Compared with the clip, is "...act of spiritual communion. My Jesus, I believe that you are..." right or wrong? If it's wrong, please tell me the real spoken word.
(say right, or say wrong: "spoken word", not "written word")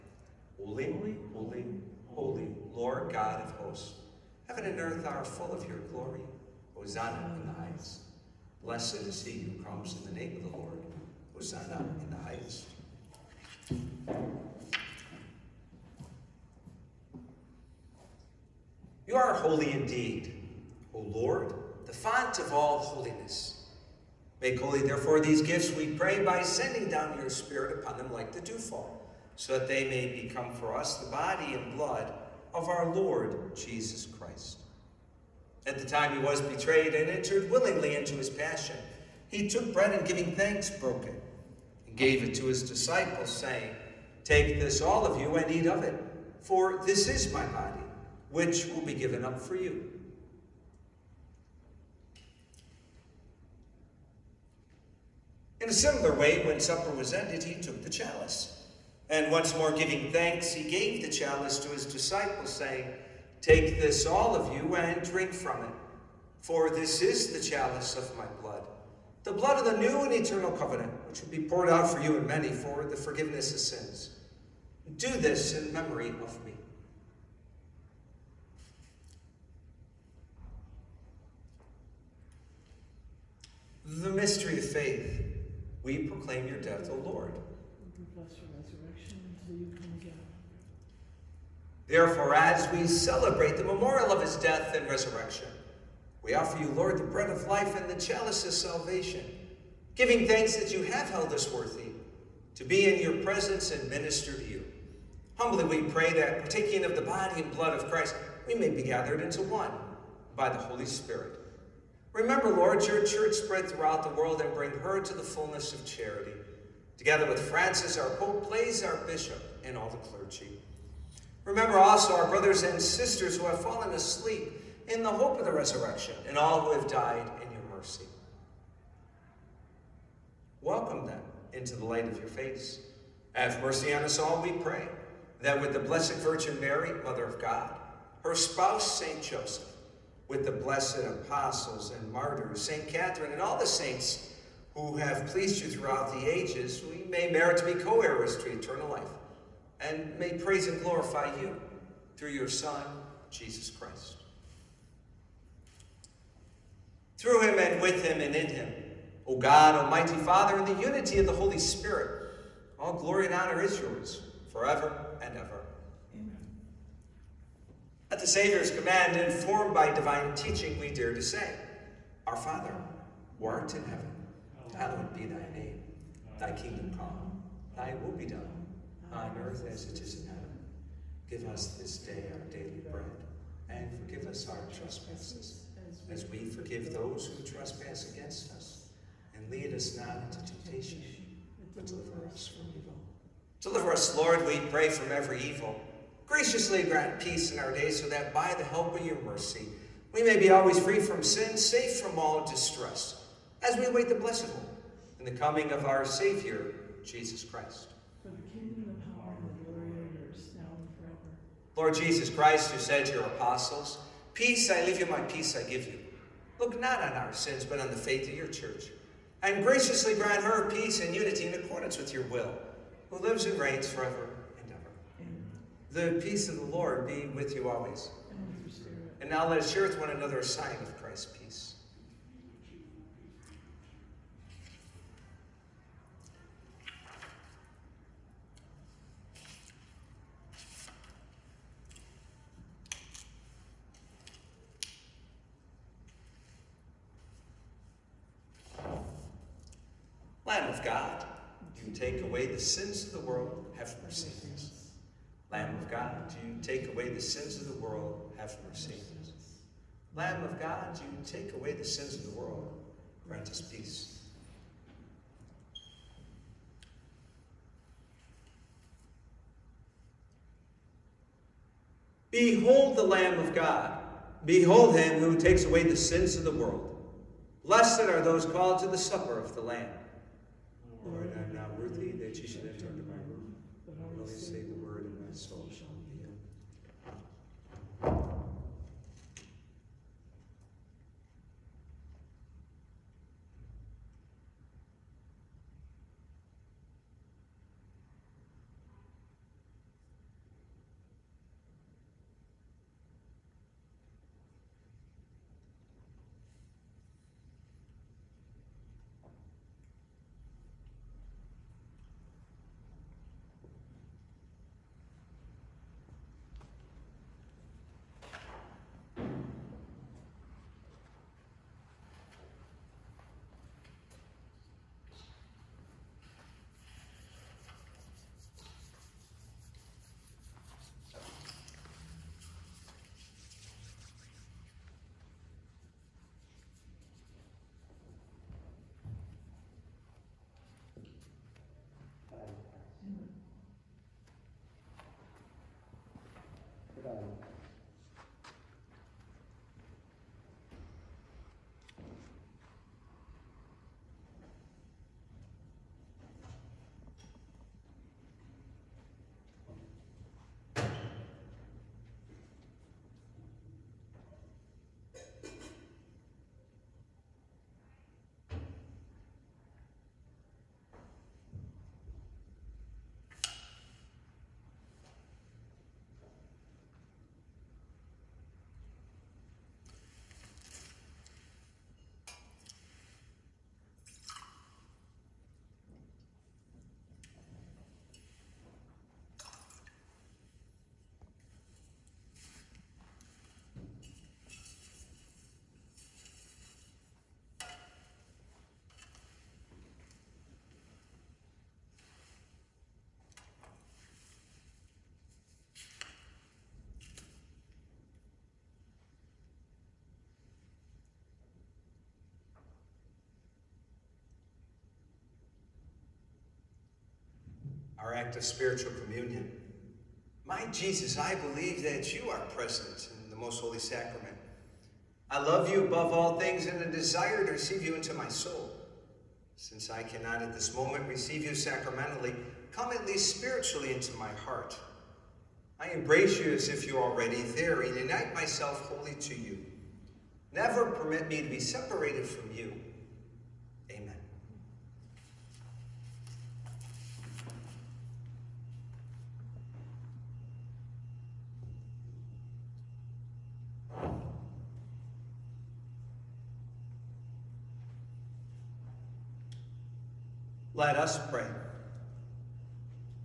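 right.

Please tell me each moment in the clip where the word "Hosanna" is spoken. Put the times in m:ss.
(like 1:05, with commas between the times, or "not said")
0:06, 0:11.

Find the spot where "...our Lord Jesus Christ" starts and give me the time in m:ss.
0:32.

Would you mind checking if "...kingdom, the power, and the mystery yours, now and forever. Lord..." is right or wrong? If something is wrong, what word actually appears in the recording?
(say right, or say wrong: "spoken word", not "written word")
wrong: "glory", not "mystery".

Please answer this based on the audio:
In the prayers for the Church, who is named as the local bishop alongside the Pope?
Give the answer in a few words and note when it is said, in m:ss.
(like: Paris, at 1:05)
Blaise, at 1:58.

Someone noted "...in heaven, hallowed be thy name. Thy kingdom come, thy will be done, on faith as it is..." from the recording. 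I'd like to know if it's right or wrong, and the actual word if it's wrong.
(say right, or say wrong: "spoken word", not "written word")
wrong: "earth", not "faith".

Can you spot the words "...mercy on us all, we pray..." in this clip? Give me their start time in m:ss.
2:13.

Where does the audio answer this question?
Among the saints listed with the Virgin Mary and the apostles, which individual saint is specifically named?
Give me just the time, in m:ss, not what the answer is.
2:22.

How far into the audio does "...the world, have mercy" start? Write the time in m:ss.
4:17.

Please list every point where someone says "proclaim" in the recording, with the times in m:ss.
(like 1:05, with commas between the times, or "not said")
1:25.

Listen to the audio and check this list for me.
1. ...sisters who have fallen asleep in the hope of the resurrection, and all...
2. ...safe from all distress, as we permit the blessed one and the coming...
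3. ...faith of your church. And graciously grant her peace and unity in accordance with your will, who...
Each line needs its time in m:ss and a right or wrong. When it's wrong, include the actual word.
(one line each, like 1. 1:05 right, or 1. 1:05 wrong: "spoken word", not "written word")
1. 2:02 right
2. 3:21 wrong: "await", not "permit"
3. 3:37 right.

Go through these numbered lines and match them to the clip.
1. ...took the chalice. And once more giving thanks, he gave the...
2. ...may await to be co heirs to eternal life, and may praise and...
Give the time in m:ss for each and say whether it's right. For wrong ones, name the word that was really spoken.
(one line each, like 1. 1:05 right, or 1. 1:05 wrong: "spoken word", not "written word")
1. 0:57 right
2. 2:27 wrong: "merit", not "await".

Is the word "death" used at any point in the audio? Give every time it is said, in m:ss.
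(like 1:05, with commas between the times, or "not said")
1:26, 1:34.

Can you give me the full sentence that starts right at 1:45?
Humbly we pray that, partaking of the body and blood of Christ, we may be gathered into one by the Holy Spirit.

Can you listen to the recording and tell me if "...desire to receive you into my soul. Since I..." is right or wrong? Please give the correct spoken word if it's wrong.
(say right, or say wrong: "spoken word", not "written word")
right.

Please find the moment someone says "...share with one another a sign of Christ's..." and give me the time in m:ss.
3:49.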